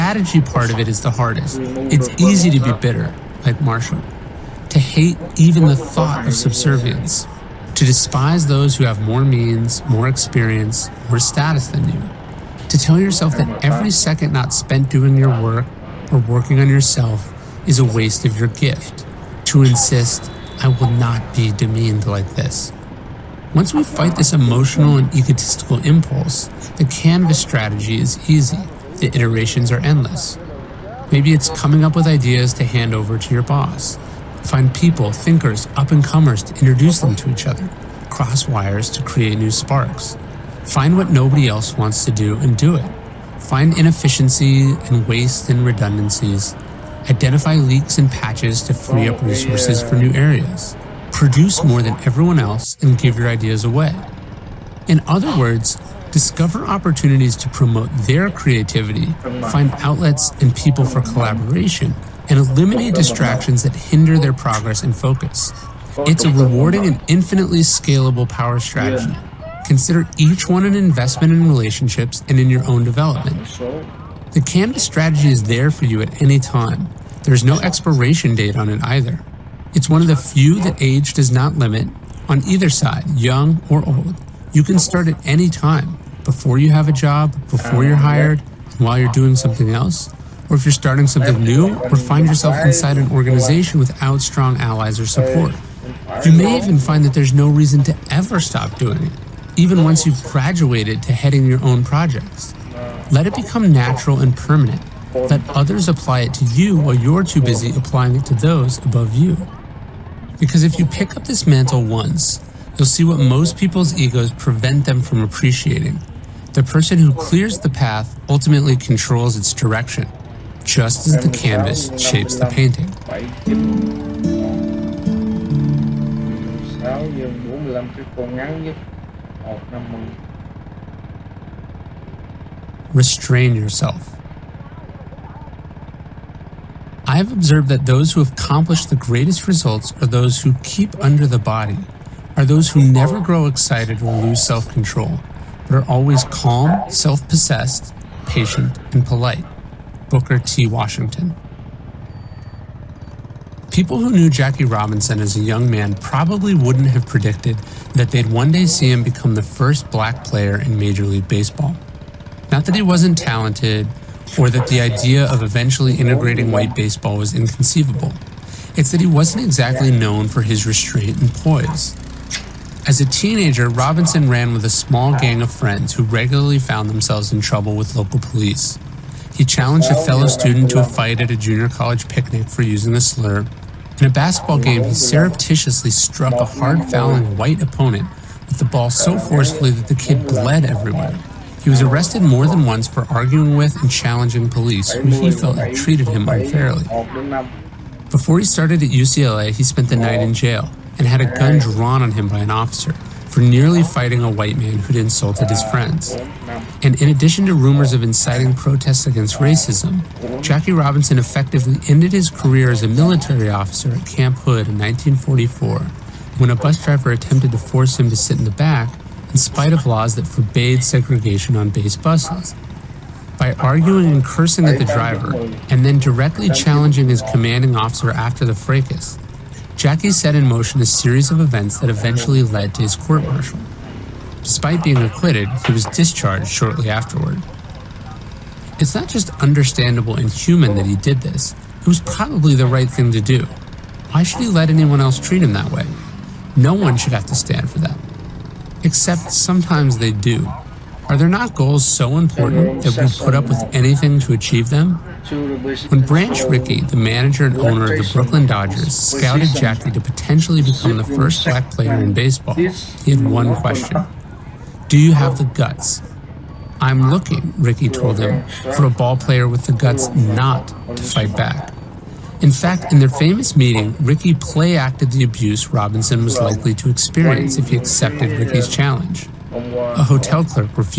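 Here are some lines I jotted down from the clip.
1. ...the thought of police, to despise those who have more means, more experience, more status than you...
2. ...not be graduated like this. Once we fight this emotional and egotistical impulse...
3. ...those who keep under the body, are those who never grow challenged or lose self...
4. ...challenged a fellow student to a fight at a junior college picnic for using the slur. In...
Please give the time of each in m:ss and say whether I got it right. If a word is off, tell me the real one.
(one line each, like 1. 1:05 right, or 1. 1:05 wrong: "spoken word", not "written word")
1. 0:05 wrong: "subservience", not "police"
2. 0:20 wrong: "demeaned", not "graduated"
3. 2:20 wrong: "excited", not "challenged"
4. 2:59 right.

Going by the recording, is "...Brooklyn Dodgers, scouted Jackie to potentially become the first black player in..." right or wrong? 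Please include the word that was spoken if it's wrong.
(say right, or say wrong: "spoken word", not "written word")
right.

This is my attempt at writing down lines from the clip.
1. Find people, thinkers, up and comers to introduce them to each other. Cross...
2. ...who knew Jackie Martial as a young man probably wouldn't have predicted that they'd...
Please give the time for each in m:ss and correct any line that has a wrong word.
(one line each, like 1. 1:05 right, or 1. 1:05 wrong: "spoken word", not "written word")
1. 0:34 right
2. 2:33 wrong: "Robinson", not "Martial".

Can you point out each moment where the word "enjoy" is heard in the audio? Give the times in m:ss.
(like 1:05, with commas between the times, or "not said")
not said.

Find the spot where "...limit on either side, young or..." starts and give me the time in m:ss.
1:21.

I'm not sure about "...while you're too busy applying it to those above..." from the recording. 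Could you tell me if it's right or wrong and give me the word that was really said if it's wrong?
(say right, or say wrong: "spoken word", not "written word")
right.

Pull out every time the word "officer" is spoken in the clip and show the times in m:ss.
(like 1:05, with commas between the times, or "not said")
3:22, 3:33, 3:47.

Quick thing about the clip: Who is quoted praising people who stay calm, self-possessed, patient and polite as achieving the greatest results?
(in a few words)
Booker T. Washington.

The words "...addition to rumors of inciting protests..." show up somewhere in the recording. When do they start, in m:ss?
3:27.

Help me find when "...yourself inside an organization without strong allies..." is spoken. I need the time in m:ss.
1:32.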